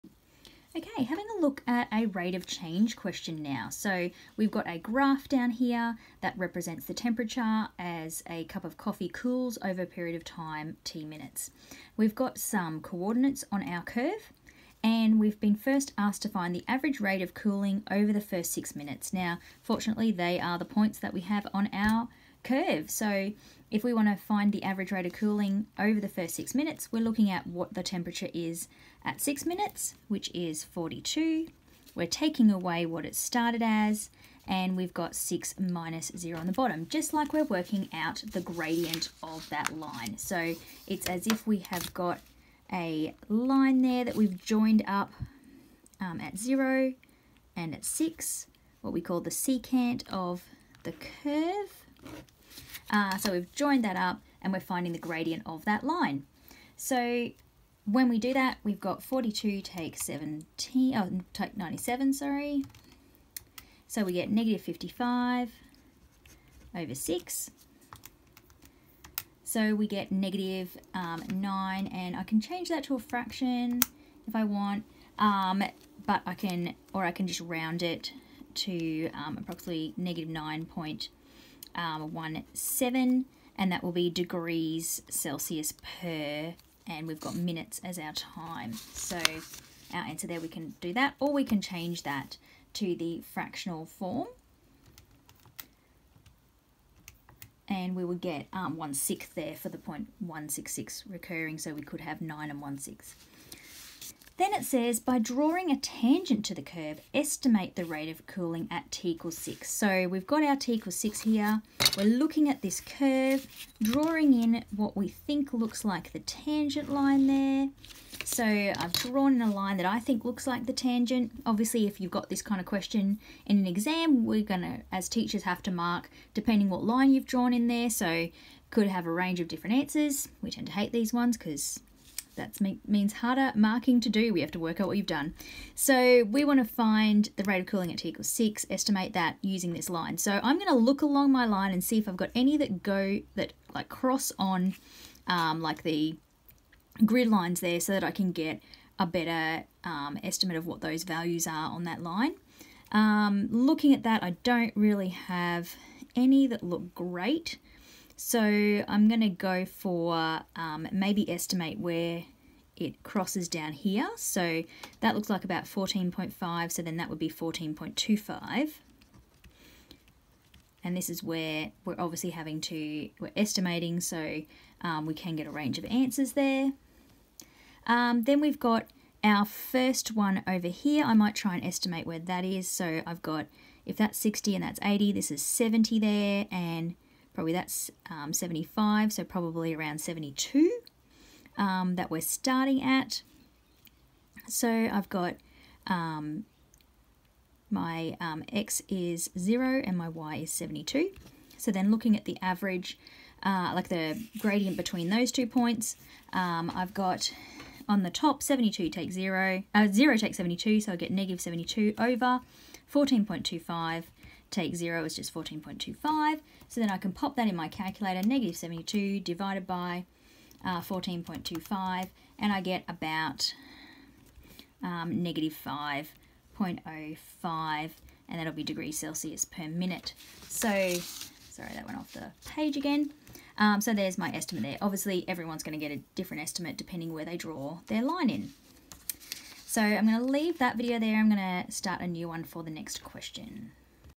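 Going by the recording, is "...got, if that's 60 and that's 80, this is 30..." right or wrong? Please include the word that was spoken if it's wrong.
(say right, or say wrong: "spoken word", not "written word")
wrong: "70", not "30".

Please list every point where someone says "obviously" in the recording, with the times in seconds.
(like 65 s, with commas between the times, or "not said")
121 s, 171 s, 234 s.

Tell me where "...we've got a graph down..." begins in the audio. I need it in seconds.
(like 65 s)
4 s.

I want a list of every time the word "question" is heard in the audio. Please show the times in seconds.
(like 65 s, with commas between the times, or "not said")
2 s, 122 s, 243 s.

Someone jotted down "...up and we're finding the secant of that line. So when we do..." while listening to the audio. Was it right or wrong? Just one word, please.
wrong.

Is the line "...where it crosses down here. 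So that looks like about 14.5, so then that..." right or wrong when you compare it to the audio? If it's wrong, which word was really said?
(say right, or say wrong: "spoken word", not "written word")
right.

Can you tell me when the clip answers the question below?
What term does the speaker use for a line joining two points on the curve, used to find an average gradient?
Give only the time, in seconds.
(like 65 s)
49 s.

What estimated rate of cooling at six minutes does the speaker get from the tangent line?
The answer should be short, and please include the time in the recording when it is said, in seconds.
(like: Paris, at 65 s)
-5.05 degrees Celsius per minute, at 225 s.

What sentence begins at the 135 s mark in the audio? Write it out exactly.
So we want to find the rate of cooling at t equals 6, estimate that using this line.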